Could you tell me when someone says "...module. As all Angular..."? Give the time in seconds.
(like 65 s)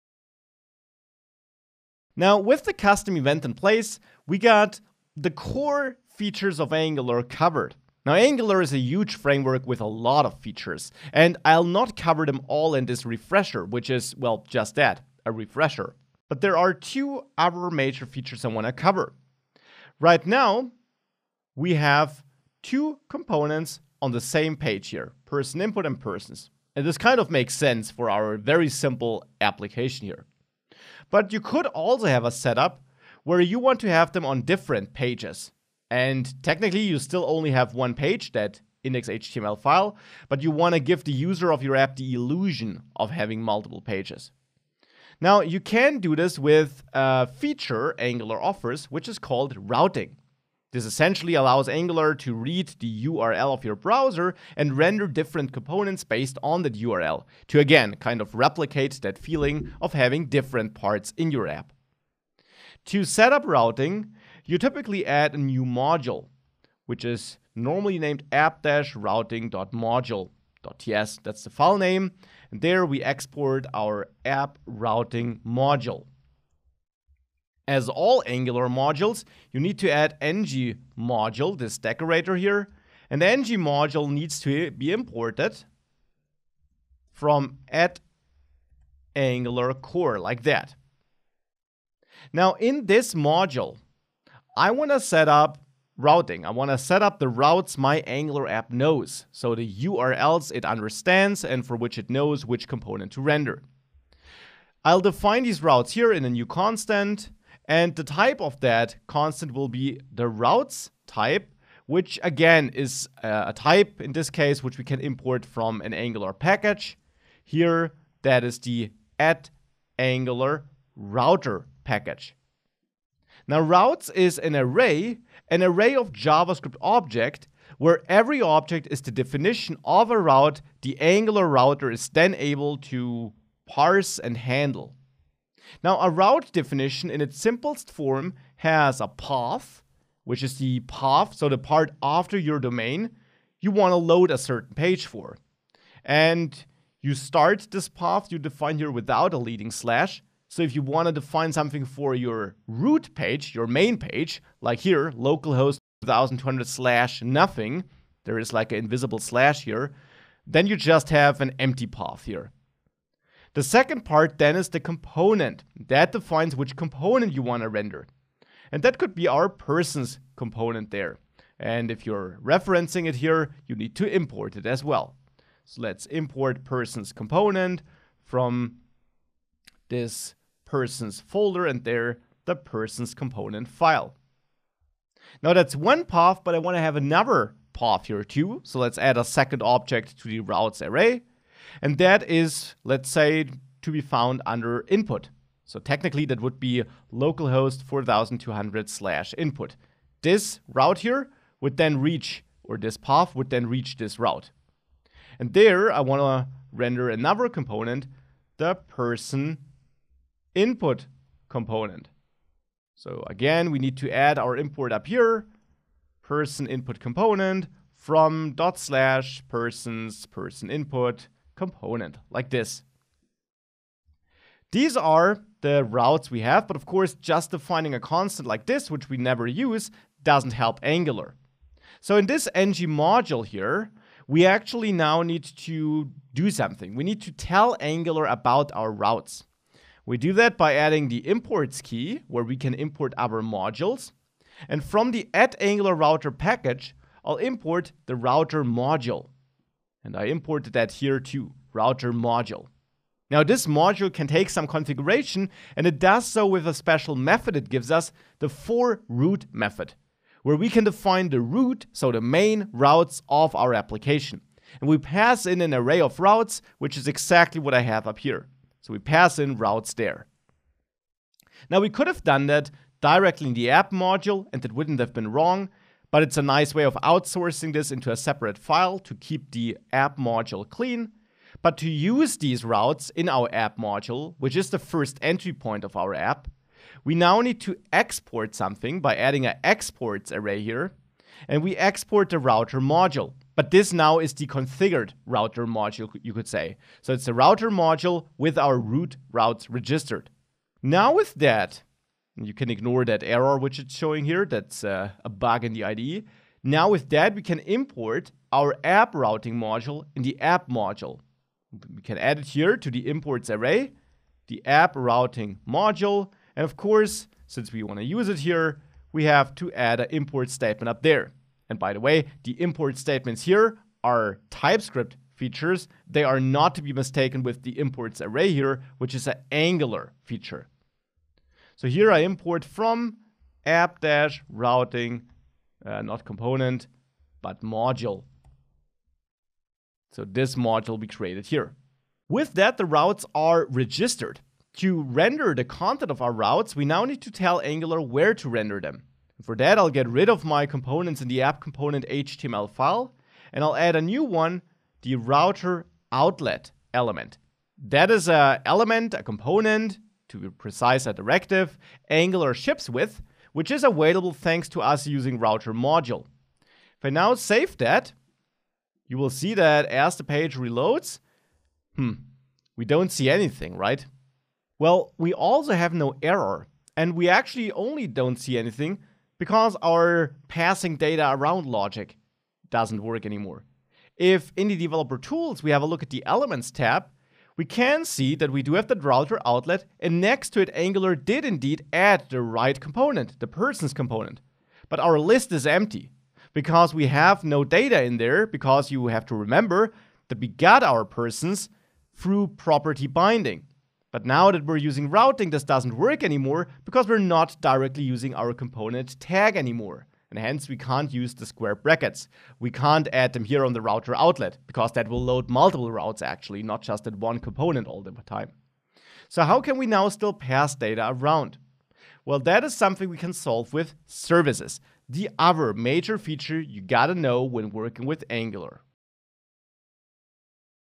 75 s.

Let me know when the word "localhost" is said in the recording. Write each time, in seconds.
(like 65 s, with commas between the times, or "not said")
155 s, 197 s.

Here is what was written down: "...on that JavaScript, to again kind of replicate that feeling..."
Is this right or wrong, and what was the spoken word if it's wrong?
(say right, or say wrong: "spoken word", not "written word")
wrong: "URL", not "JavaScript".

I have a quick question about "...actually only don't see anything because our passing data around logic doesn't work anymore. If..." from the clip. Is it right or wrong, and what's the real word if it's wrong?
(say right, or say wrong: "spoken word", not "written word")
right.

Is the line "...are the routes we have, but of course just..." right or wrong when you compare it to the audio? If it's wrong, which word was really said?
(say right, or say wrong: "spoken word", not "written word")
right.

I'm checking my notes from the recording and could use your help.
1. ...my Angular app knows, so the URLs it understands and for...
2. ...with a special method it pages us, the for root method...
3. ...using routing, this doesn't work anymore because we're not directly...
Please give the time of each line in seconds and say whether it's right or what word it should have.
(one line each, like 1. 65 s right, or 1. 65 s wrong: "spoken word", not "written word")
1. 97 s right
2. 256 s wrong: "gives", not "pages"
3. 404 s right.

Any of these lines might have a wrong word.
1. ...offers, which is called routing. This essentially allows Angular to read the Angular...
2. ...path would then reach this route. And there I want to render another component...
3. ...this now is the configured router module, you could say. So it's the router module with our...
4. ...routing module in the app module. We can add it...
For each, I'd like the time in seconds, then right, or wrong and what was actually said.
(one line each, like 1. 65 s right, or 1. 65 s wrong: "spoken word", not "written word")
1. 48 s wrong: "URL", not "Angular"
2. 202 s right
3. 293 s right
4. 309 s right.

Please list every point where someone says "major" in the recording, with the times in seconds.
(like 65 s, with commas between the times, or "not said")
17 s, 425 s.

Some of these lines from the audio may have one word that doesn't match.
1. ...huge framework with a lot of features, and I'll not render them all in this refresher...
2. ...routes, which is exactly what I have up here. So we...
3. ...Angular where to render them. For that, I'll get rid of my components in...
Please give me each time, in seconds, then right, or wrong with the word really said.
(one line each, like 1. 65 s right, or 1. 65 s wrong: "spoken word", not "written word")
1. 8 s wrong: "cover", not "render"
2. 266 s right
3. 347 s right.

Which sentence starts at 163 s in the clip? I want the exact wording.
The second part then is the component.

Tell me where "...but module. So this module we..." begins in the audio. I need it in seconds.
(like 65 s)
337 s.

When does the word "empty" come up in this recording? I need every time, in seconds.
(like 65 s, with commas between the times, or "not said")
161 s, 395 s.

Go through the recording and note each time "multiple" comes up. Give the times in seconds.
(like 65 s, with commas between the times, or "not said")
43 s, 415 s.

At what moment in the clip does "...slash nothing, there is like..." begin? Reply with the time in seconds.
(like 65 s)
156 s.